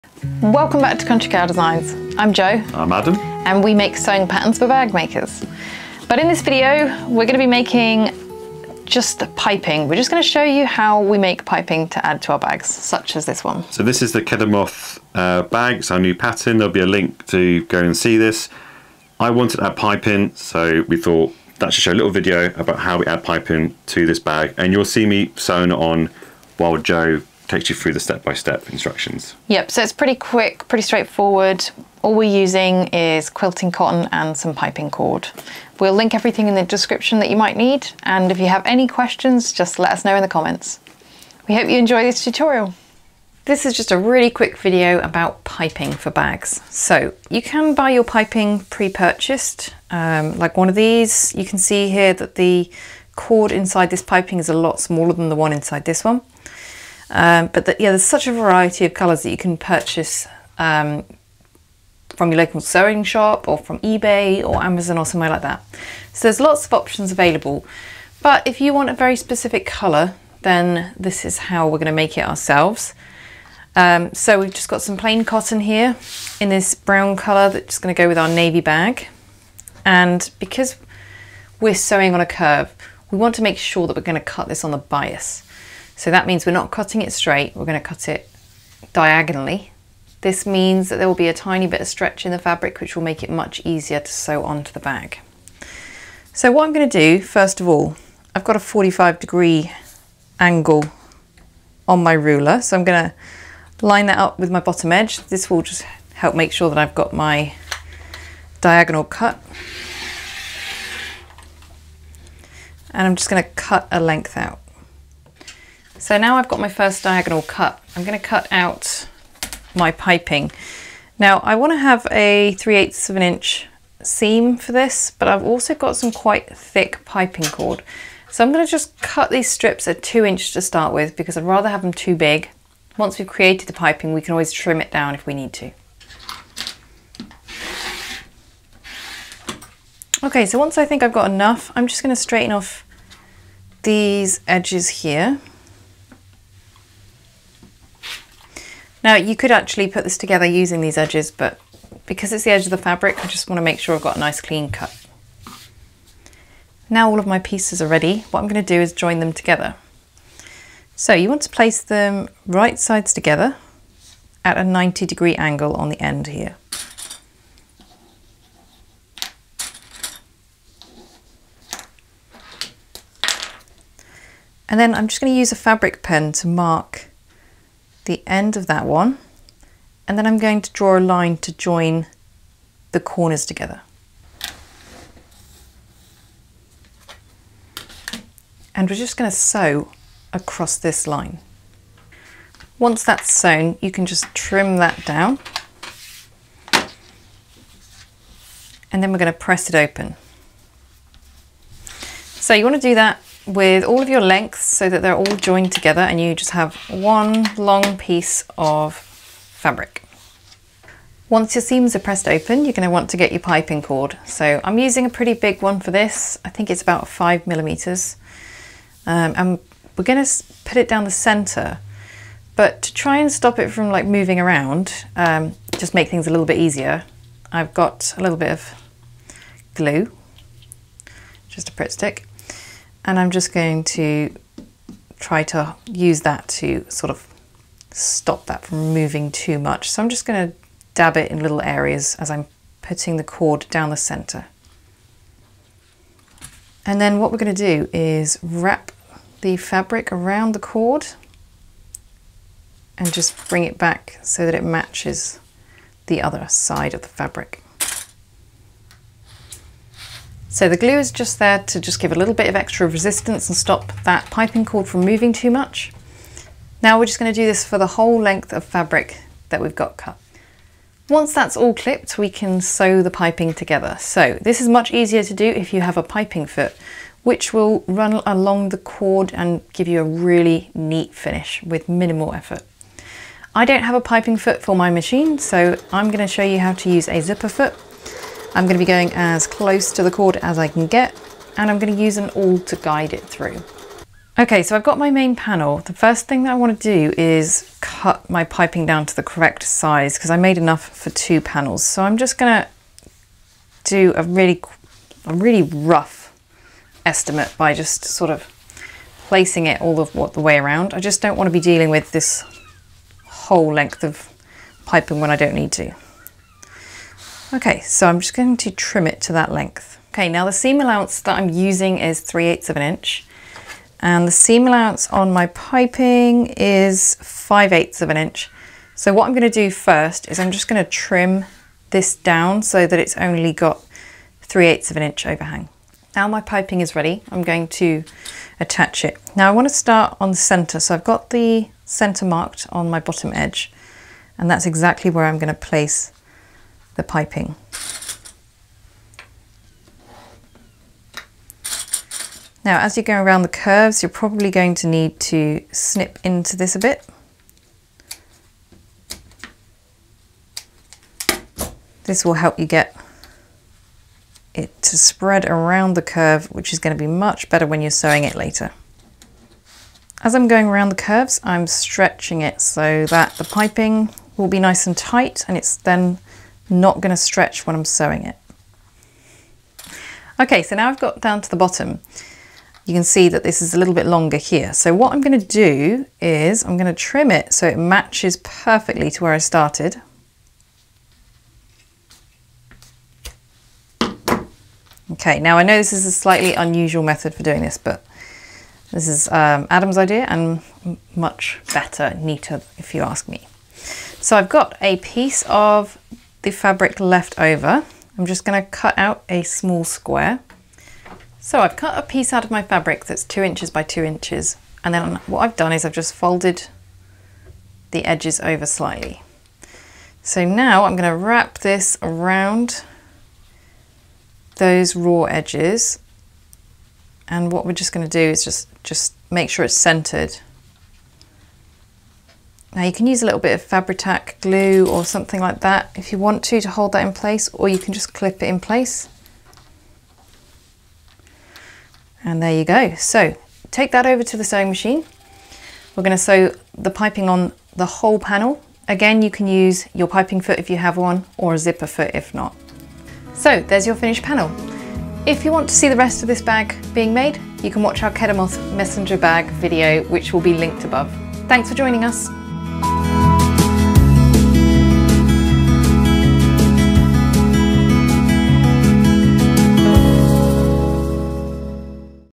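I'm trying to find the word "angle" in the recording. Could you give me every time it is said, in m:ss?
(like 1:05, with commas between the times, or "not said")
1:40, 2:45.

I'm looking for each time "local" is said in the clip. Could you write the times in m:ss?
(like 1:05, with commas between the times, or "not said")
1:02.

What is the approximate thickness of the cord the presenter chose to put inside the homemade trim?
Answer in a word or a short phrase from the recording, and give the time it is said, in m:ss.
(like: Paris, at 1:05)
5 millimeters, at 3:37.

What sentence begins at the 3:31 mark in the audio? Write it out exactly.
Once your seams are pressed open, you're going to want to get your piping cord.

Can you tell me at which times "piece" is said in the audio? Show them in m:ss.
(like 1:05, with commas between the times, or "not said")
2:37, 3:27, 6:44, 6:52.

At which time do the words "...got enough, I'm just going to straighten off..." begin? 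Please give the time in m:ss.
2:21.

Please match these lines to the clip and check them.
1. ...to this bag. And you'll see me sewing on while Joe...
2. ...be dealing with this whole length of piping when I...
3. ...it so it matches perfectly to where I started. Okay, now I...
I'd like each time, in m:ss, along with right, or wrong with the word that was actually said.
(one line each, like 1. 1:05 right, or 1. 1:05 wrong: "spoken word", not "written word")
1. 0:23 right
2. 5:11 right
3. 6:27 right.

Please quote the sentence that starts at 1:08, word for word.
But if you want a very specific colour, then this is how we're going to make it ourselves.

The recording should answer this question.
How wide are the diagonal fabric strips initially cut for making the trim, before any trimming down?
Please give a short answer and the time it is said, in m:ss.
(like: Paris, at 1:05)
2 inches, at 2:10.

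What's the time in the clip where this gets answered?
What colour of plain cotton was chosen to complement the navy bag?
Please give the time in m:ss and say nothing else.
1:16.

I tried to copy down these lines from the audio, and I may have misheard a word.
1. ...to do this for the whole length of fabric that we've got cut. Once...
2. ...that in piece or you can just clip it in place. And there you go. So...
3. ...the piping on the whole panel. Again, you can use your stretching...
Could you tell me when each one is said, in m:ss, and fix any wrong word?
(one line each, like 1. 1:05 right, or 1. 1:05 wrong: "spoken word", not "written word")
1. 4:27 right
2. 7:16 wrong: "place", not "piece"
3. 7:26 wrong: "piping", not "stretching".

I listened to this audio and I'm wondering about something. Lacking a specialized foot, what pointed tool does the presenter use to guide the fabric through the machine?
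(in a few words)
An awl.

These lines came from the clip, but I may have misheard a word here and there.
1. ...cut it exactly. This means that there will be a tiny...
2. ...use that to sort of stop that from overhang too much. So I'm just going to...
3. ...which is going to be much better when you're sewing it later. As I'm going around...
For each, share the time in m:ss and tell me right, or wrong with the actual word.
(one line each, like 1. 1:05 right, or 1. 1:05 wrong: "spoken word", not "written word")
1. 1:27 wrong: "diagonally", not "exactly"
2. 3:55 wrong: "moving", not "overhang"
3. 6:06 right.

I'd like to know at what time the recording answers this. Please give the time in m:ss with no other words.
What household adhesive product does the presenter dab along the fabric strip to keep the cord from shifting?
3:51.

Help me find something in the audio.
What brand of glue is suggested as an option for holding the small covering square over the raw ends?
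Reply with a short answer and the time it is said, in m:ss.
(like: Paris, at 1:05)
Fabri-Tac, at 7:13.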